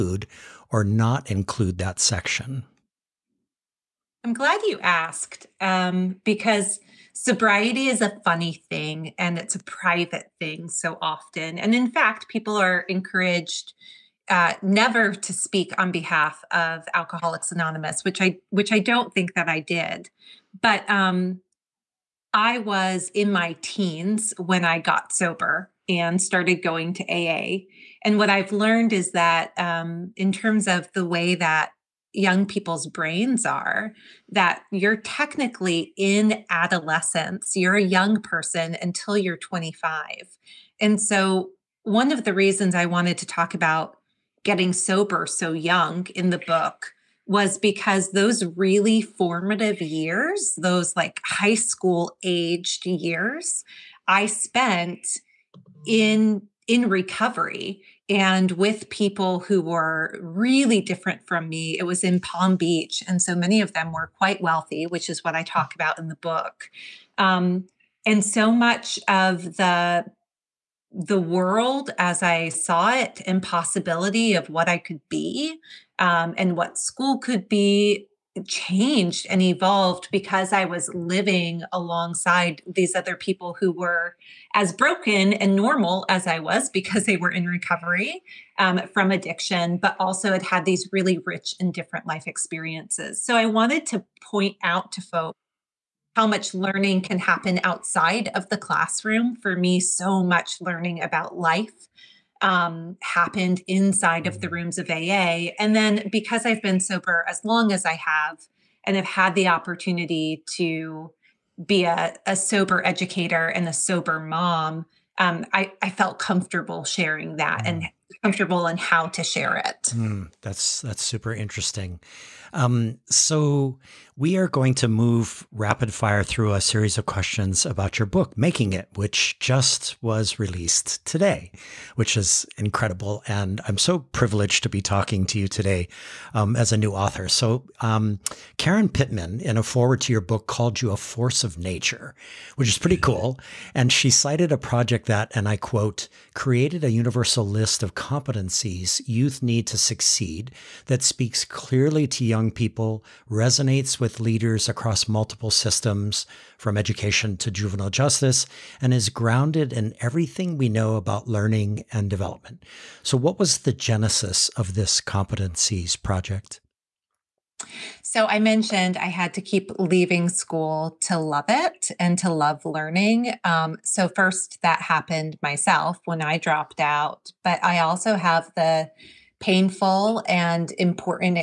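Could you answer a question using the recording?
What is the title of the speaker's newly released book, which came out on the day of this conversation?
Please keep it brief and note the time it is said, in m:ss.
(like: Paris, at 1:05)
Making It, at 2:08.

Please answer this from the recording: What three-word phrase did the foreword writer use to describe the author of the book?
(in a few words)
force of nature.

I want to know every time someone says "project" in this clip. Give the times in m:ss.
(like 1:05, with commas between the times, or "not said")
2:24, 2:46.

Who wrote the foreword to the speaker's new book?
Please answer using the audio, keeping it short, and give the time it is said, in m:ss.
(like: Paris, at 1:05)
Karen Pittman, at 2:18.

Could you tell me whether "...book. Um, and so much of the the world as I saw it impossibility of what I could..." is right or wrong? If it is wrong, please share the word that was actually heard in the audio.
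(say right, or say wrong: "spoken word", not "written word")
right.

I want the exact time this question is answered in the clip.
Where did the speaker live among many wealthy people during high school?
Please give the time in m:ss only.
1:02.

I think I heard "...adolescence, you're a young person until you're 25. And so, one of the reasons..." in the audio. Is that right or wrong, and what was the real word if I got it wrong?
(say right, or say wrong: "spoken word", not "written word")
right.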